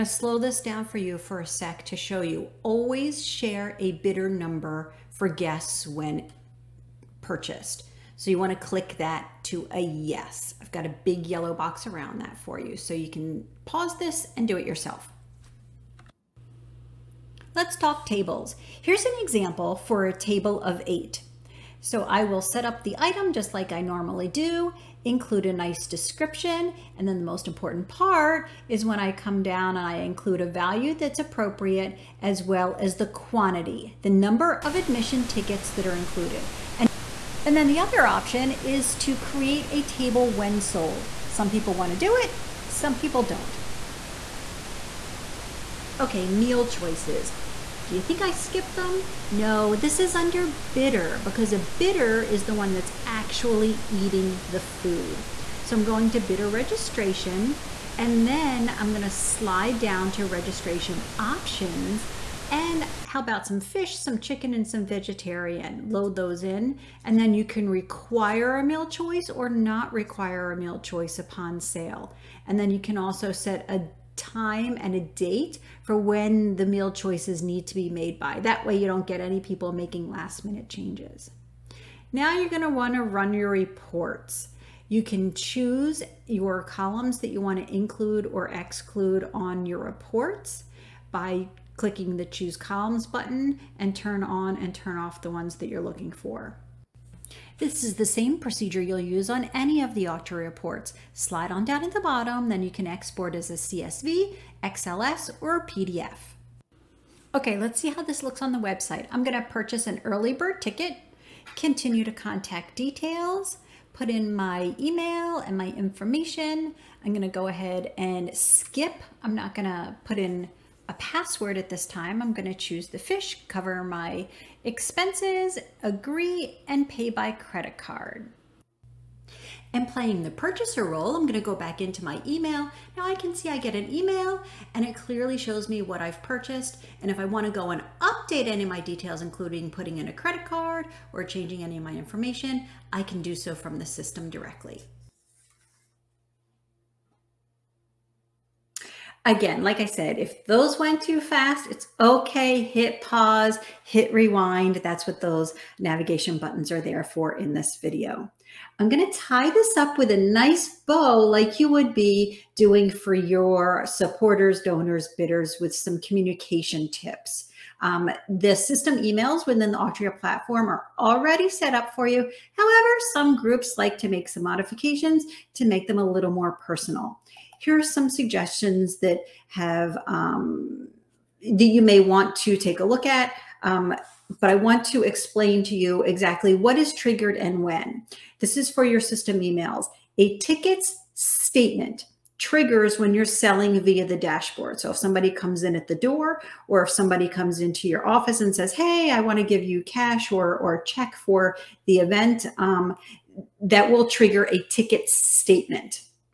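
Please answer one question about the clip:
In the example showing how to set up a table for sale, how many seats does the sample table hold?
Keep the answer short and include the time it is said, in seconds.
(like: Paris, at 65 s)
8, at 20 s.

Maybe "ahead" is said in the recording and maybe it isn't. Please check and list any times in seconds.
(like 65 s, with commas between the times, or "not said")
117 s.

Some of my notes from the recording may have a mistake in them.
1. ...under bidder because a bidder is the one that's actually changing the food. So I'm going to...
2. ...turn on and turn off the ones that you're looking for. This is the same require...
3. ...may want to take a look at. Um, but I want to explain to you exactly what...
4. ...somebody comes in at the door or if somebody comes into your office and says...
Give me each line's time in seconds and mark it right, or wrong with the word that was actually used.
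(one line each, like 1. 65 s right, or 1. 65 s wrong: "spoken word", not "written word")
1. 50 s wrong: "eating", not "changing"
2. 93 s wrong: "procedure", not "require"
3. 181 s right
4. 194 s right.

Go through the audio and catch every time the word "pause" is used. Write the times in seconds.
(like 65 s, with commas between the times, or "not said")
13 s, 153 s.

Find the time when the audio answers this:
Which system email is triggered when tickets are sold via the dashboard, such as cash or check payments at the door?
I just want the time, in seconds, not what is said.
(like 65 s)
190 s.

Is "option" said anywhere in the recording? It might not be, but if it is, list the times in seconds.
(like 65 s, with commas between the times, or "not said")
38 s, 61 s.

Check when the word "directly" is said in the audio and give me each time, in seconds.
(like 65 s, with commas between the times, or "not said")
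144 s.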